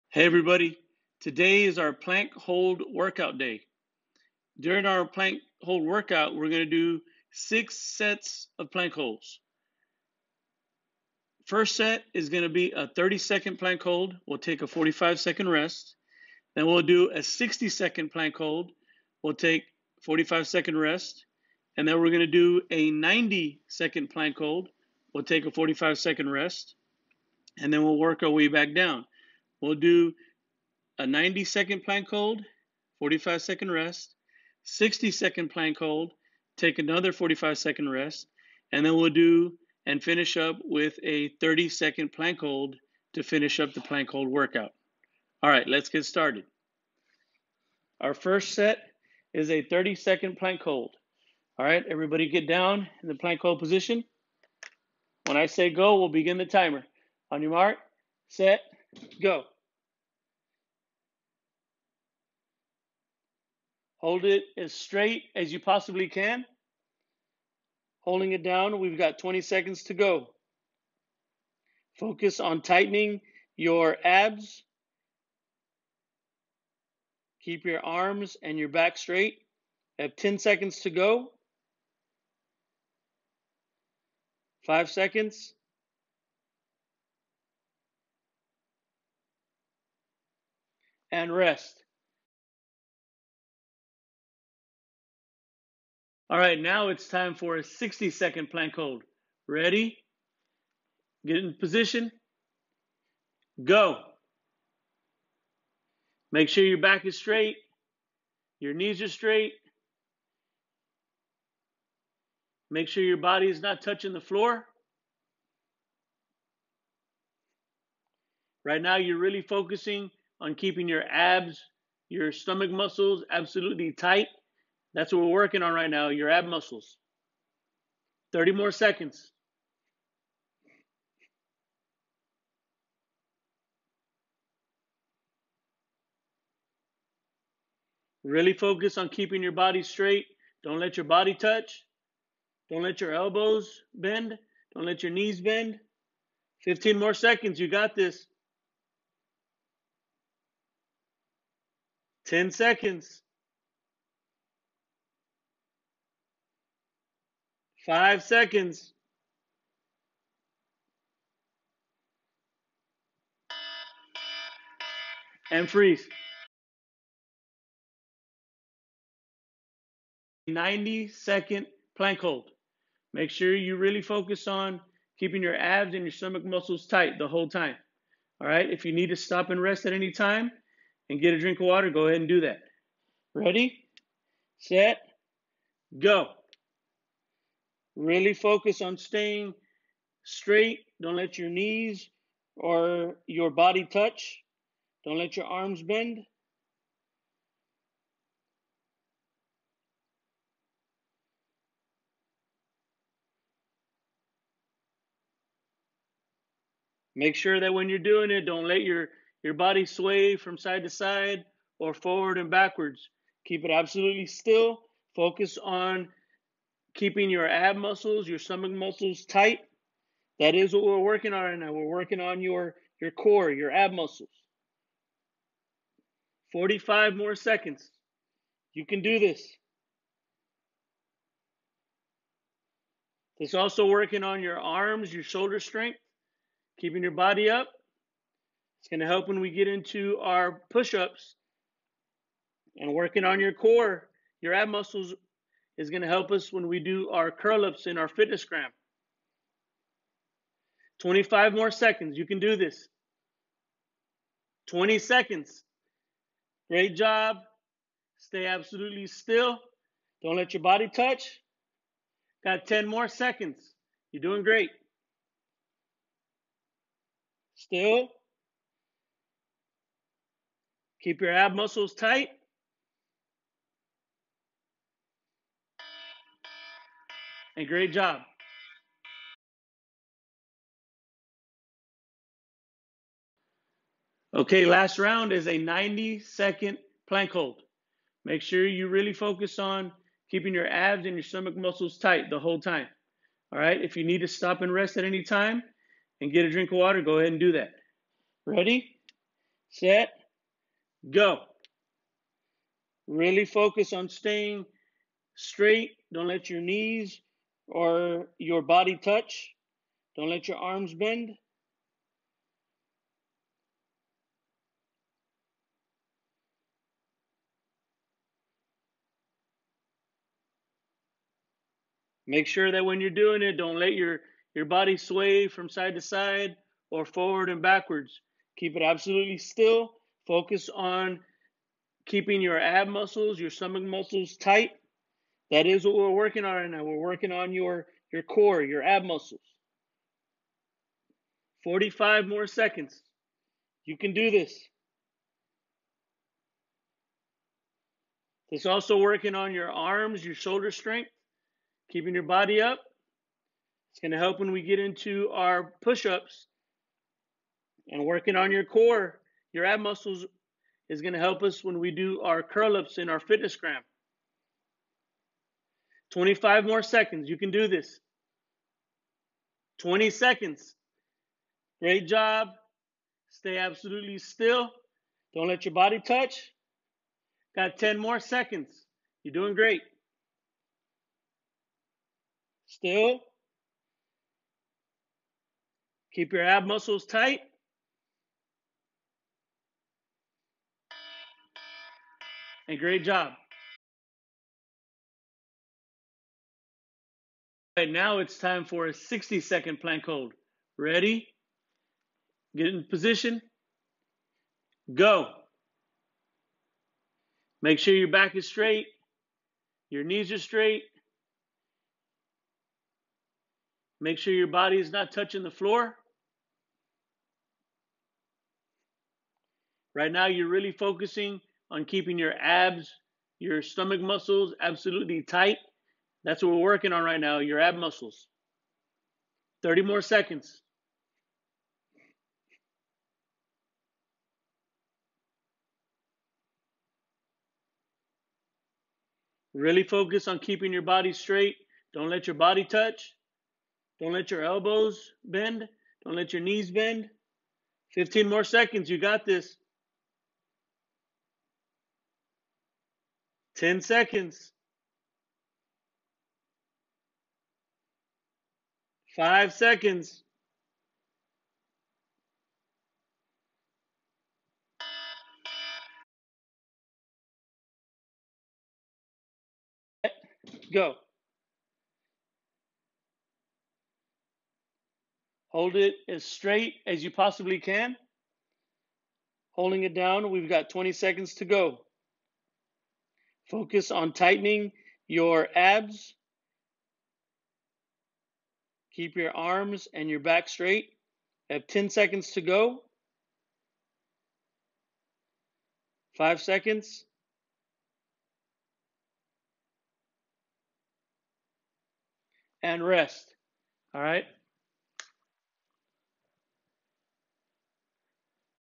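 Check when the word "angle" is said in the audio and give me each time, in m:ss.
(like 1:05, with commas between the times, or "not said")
not said.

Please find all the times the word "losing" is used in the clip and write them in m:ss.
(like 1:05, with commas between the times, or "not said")
not said.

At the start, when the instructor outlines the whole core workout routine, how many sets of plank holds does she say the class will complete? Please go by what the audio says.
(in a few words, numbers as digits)
6.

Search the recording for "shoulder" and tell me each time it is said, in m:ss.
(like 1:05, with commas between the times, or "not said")
3:55, 5:50.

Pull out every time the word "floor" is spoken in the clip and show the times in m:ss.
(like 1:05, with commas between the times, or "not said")
1:54, 6:55.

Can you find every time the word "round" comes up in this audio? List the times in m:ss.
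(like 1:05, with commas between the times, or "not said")
4:44.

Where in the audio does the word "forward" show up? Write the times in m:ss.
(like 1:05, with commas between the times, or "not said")
3:31, 5:27.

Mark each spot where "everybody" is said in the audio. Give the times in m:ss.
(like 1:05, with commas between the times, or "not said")
0:00, 0:51.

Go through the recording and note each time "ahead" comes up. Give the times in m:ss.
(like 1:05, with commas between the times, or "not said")
3:02, 4:57.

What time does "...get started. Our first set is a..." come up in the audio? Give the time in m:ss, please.
0:45.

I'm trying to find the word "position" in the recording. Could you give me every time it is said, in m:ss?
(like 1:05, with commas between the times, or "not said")
0:53, 1:41, 6:42.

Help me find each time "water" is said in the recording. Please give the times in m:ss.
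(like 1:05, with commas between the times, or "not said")
3:01, 4:56.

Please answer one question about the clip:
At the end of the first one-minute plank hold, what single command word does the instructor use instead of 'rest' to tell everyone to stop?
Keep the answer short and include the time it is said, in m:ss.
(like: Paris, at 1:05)
Freeze, at 2:45.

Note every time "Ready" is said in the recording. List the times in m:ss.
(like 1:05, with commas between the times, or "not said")
1:39, 3:03, 4:58, 6:40.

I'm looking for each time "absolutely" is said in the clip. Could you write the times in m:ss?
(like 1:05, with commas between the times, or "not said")
2:03, 3:33, 4:18, 5:28, 6:13, 7:04.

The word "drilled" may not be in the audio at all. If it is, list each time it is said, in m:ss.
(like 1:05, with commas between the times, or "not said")
not said.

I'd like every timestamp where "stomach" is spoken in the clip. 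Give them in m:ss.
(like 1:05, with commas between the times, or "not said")
2:02, 2:56, 3:38, 4:51, 5:33, 7:03.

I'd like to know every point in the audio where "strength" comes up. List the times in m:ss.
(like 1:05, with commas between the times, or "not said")
3:55, 5:50.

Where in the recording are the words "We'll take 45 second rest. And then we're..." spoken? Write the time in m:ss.
0:19.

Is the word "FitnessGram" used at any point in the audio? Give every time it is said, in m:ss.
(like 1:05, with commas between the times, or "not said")
4:08, 6:03.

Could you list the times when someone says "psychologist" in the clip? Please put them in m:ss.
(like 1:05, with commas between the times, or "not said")
not said.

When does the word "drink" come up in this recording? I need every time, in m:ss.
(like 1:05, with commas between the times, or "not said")
3:01, 4:56.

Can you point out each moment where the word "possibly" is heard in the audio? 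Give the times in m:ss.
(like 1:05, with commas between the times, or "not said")
1:05, 7:57.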